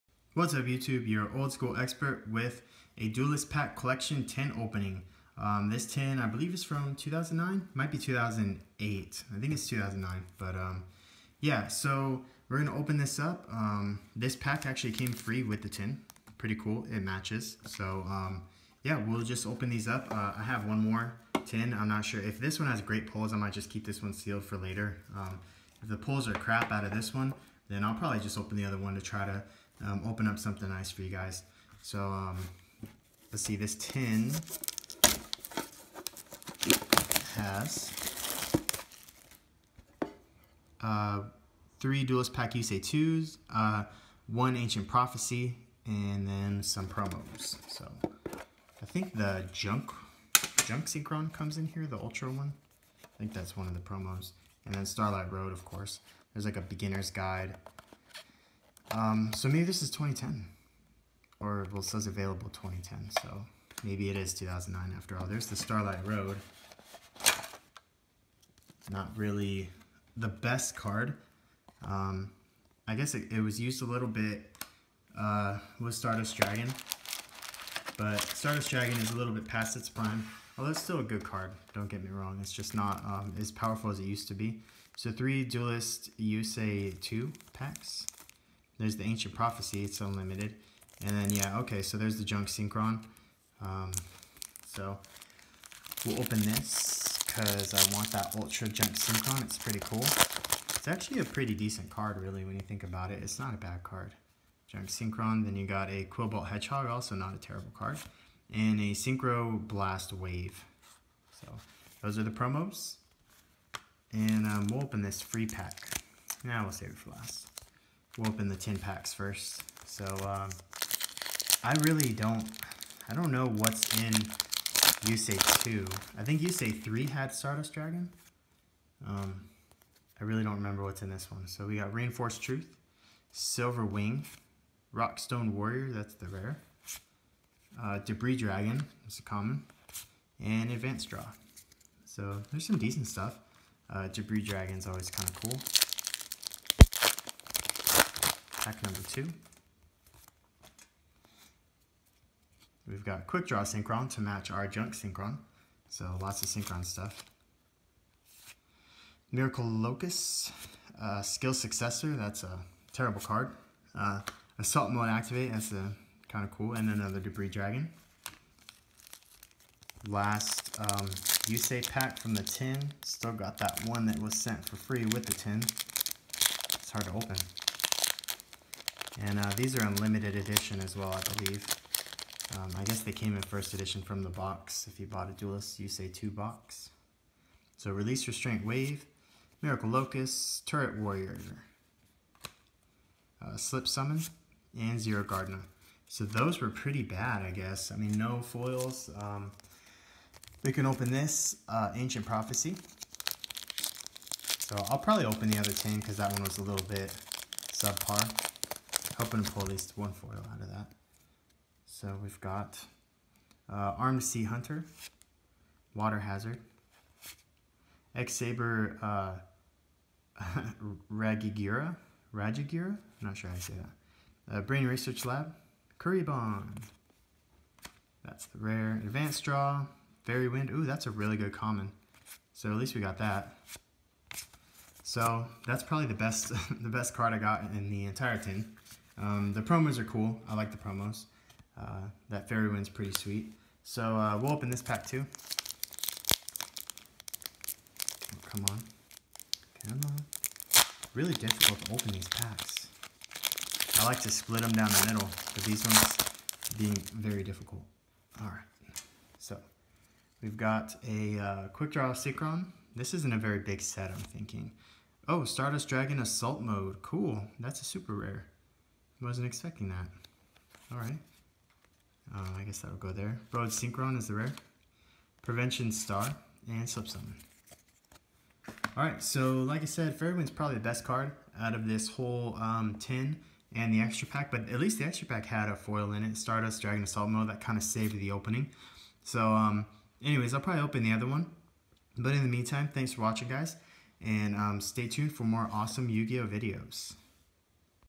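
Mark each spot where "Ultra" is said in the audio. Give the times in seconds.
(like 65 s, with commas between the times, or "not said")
51 s, 98 s.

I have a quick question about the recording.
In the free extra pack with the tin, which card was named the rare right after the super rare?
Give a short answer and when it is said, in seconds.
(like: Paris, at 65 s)
Road Synchron, at 273 s.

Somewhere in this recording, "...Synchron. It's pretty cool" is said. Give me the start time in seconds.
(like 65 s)
98 s.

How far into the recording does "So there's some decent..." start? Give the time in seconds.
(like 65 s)
142 s.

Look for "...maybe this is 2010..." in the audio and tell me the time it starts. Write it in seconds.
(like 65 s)
59 s.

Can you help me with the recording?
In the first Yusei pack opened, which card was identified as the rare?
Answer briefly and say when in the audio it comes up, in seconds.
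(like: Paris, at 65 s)
Rockstone Warrior, at 134 s.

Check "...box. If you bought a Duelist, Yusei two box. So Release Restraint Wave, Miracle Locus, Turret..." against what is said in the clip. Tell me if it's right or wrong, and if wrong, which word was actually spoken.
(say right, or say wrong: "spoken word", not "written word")
right.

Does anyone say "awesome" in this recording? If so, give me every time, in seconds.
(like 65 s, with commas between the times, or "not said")
295 s.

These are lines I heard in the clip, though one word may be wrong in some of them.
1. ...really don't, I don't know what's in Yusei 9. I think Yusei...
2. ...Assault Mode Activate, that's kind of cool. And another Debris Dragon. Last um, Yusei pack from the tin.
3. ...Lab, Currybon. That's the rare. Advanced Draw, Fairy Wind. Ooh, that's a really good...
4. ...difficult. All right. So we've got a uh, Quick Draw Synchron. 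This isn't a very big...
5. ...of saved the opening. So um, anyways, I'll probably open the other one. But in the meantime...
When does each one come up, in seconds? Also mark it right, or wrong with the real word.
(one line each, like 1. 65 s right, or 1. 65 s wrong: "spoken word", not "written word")
1. 121 s wrong: "2", not "9"
2. 164 s right
3. 225 s right
4. 257 s right
5. 287 s right.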